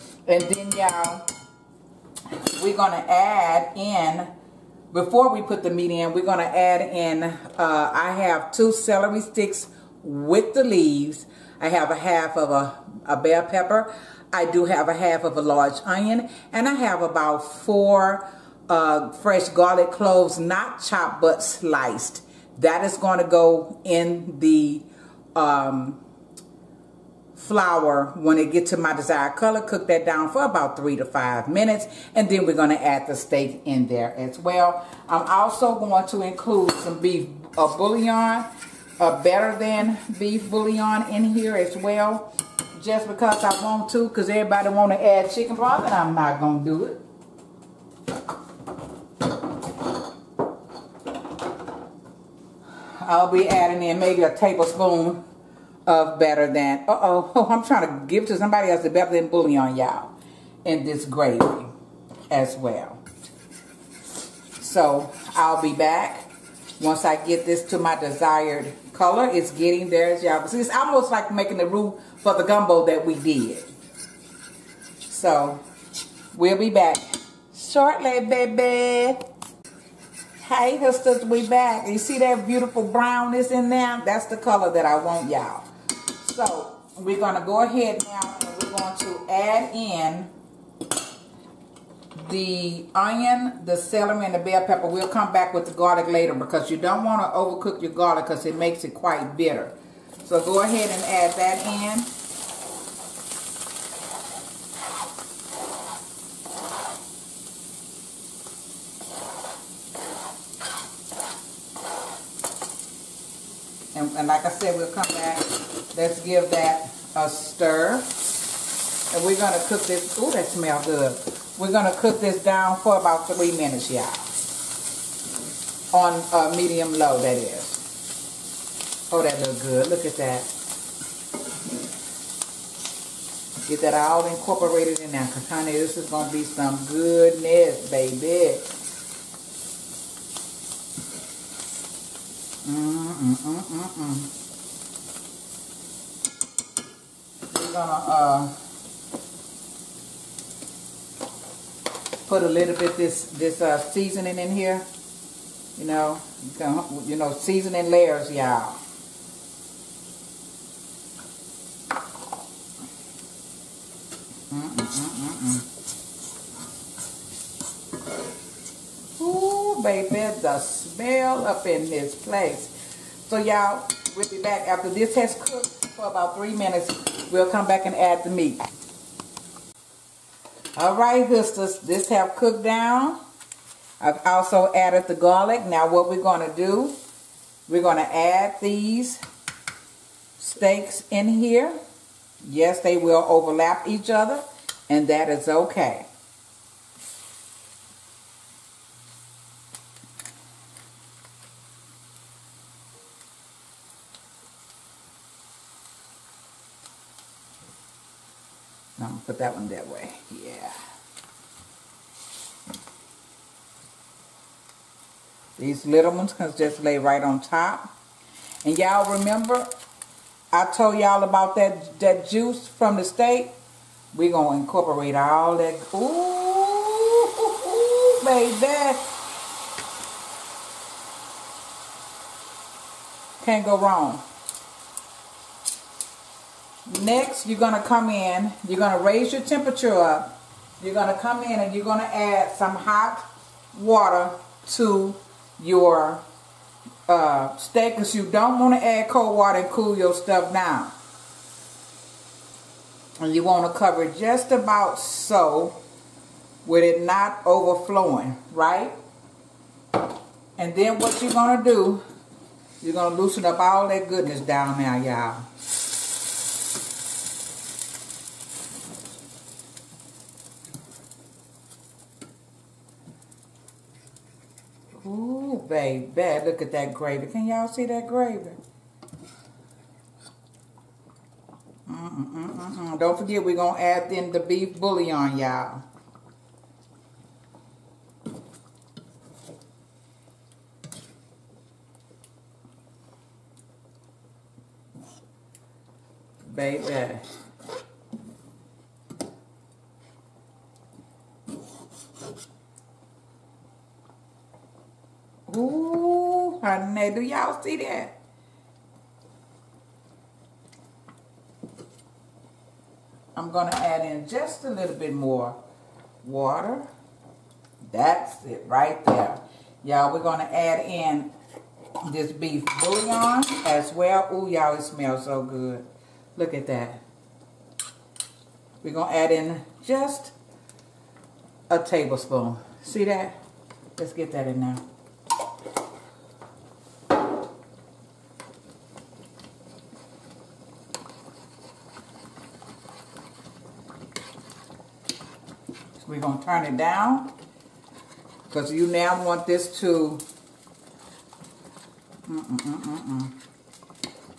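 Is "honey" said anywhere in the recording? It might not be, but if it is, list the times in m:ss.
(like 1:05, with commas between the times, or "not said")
2:15.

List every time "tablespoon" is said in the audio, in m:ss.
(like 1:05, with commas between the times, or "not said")
0:54, 5:31.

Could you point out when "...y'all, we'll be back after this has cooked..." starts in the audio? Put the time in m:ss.
2:53.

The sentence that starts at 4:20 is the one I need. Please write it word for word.
And then what you're going to do, you're going to loosen up all that goodness down now, y'all.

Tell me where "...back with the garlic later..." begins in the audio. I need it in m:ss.
1:35.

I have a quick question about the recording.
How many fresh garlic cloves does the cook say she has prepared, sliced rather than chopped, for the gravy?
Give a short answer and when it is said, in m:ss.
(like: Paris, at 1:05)
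4, at 0:17.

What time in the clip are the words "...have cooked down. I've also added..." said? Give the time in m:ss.
3:02.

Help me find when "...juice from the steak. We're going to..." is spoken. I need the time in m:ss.
3:42.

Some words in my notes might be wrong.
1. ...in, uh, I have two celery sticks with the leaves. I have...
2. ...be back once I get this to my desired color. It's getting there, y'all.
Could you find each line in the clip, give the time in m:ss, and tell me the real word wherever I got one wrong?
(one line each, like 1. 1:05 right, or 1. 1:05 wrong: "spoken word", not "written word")
1. 0:06 right
2. 1:05 right.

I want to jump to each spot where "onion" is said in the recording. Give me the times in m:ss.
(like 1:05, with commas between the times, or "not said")
0:15, 1:32.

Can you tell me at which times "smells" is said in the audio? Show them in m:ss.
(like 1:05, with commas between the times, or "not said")
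2:00, 2:50, 5:24.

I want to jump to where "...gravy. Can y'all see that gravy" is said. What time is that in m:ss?
4:36.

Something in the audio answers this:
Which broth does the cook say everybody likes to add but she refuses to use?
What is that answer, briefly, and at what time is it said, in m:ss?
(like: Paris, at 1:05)
chicken broth, at 0:45.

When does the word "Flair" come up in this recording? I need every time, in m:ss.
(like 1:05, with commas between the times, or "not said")
not said.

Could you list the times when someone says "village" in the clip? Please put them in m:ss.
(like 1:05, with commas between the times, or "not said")
not said.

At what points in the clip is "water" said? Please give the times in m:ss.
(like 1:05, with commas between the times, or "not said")
4:03, 4:09, 5:16.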